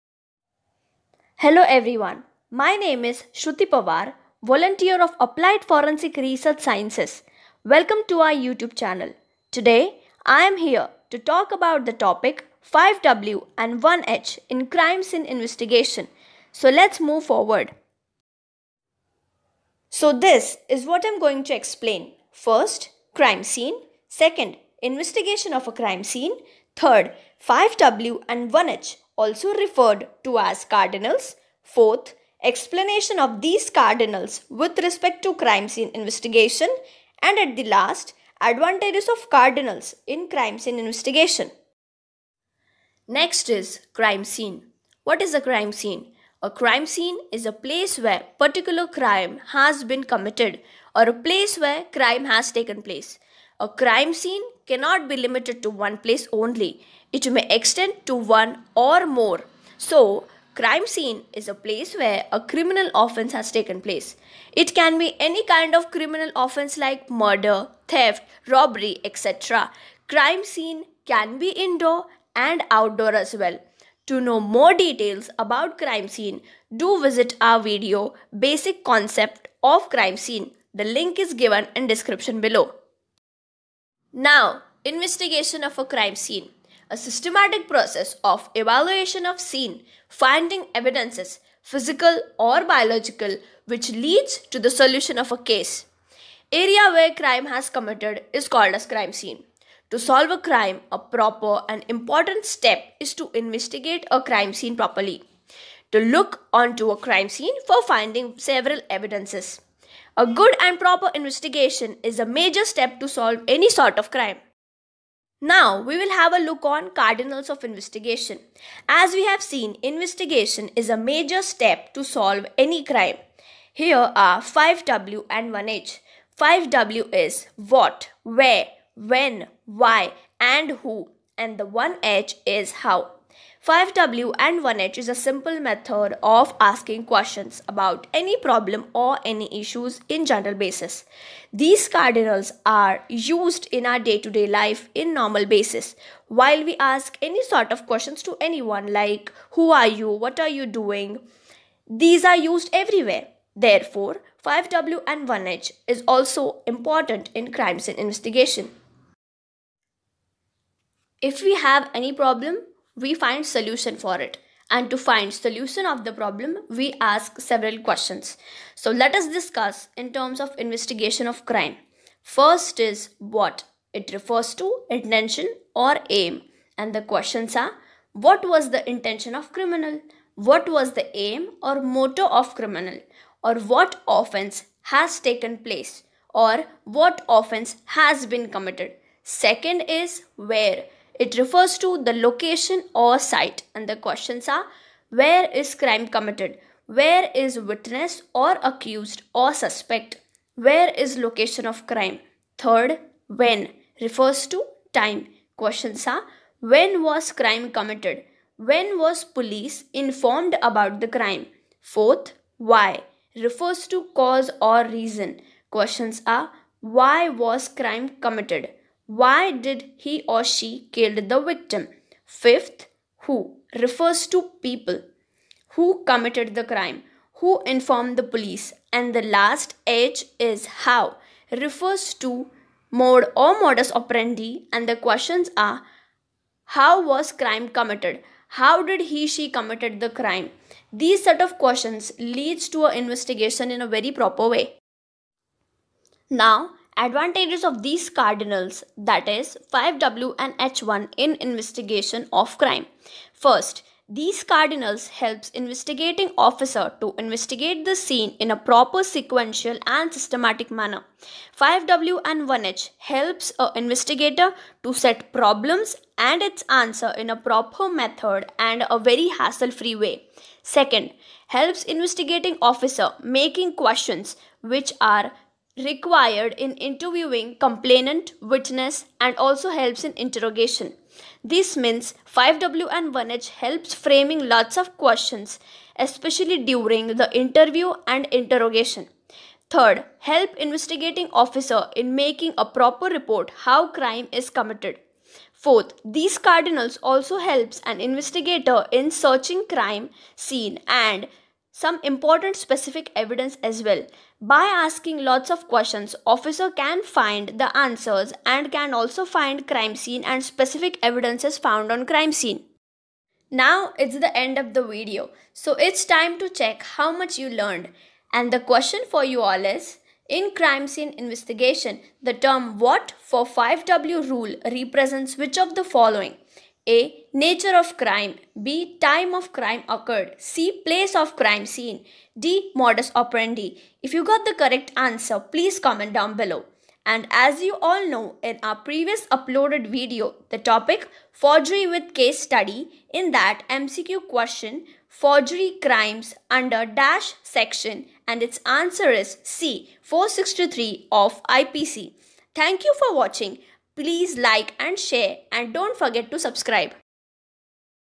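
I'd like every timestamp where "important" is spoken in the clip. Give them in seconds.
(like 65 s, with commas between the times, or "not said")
101 s, 156 s, 302 s.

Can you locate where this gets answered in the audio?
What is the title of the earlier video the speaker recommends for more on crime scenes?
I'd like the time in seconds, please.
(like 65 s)
78 s.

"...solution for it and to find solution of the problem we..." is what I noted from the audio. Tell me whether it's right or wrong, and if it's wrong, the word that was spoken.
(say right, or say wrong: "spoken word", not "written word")
right.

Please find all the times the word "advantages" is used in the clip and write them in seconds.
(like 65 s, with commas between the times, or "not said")
38 s, 246 s.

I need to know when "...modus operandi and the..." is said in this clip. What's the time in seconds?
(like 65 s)
233 s.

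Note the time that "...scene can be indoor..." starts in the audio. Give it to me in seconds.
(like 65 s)
70 s.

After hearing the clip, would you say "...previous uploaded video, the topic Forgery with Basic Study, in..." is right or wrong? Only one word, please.
wrong.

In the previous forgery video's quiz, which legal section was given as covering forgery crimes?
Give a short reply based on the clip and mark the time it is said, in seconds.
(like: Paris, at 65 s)
463 of IPC, at 350 s.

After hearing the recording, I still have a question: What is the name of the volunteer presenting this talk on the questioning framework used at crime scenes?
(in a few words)
Shruti Pawar.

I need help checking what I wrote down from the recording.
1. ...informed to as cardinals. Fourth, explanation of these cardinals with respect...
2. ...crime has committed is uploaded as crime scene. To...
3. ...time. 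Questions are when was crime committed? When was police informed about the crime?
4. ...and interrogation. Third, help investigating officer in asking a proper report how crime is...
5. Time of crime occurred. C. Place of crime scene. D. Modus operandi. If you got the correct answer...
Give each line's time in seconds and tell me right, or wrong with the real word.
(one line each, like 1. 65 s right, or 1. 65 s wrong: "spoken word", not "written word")
1. 29 s wrong: "referred", not "informed"
2. 97 s wrong: "called", not "uploaded"
3. 204 s right
4. 288 s wrong: "making", not "asking"
5. 328 s right.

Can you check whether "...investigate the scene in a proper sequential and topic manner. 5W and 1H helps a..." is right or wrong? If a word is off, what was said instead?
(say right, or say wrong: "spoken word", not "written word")
wrong: "systematic", not "topic".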